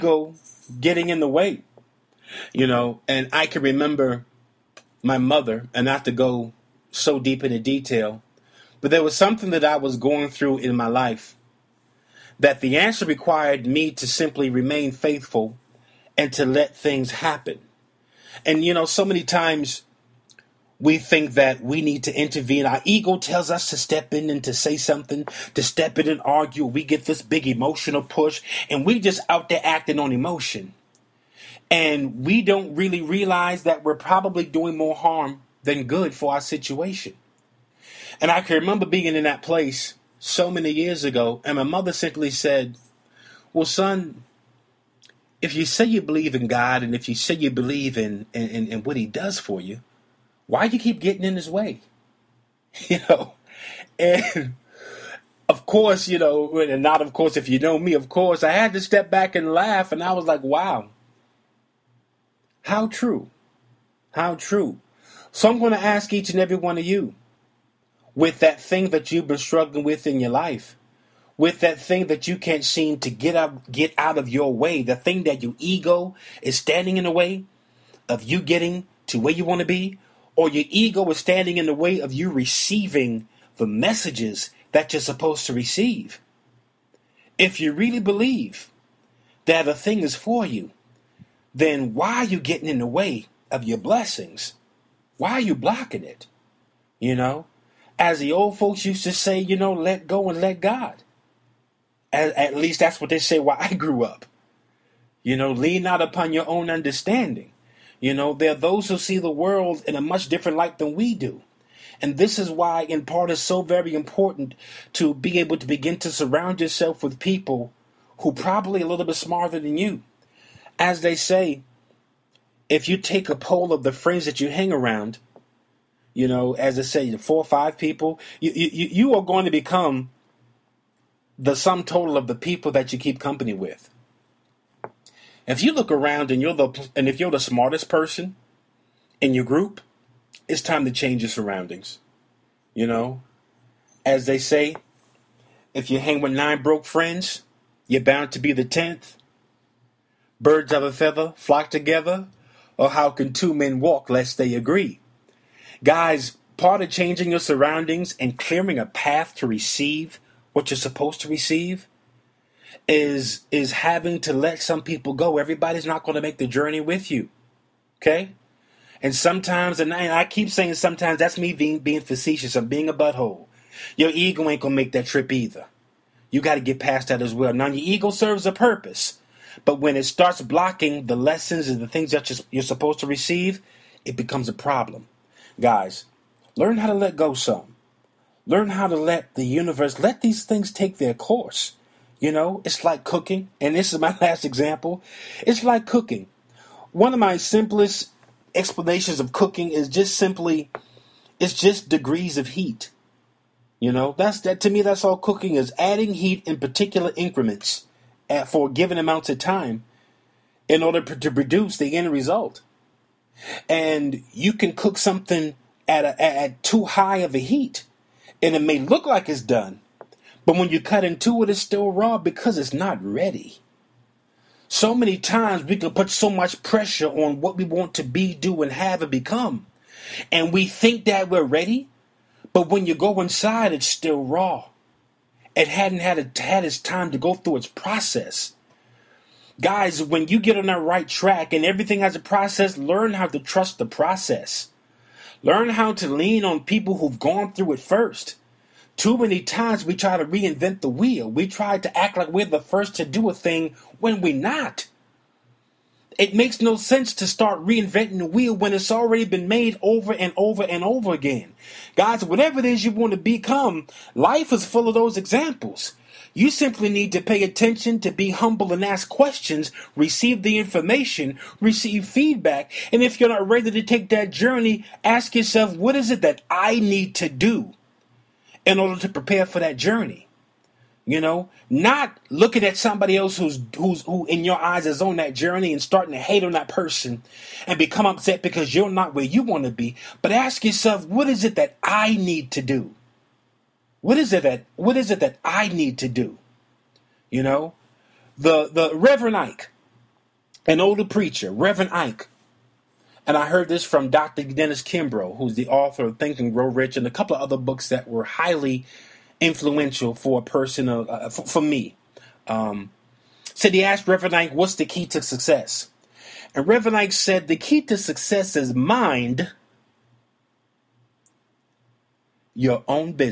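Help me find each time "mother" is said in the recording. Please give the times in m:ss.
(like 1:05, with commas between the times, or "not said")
0:05, 0:41.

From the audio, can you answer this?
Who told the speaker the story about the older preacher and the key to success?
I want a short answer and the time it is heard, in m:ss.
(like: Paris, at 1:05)
Dr. Dennis Kimbro, at 5:04.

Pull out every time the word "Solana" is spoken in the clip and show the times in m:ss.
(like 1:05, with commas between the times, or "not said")
not said.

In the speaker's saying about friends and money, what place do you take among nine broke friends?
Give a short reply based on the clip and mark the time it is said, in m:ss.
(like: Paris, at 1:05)
10th, at 2:28.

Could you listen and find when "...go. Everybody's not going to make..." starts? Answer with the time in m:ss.
2:45.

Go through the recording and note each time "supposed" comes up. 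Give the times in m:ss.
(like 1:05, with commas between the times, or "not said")
1:25, 2:40, 3:02.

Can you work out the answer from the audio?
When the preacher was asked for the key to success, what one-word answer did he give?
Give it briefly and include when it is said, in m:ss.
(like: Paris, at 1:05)
Mind, at 5:18.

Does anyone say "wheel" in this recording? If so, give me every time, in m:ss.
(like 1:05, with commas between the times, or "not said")
4:10, 4:18.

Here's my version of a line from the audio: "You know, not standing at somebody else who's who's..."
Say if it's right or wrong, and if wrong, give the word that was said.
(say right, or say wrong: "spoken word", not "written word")
wrong: "looking", not "standing".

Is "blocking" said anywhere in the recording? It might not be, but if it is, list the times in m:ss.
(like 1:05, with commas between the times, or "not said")
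1:35, 3:00.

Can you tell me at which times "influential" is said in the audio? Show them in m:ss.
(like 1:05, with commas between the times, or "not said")
5:09.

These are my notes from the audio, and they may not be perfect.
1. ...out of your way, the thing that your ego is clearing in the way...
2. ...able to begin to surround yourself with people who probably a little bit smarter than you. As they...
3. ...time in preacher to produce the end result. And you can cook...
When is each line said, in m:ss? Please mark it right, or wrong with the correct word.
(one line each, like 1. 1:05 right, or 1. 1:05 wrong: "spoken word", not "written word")
1. 1:13 wrong: "standing", not "clearing"
2. 1:55 right
3. 3:29 wrong: "order", not "preacher".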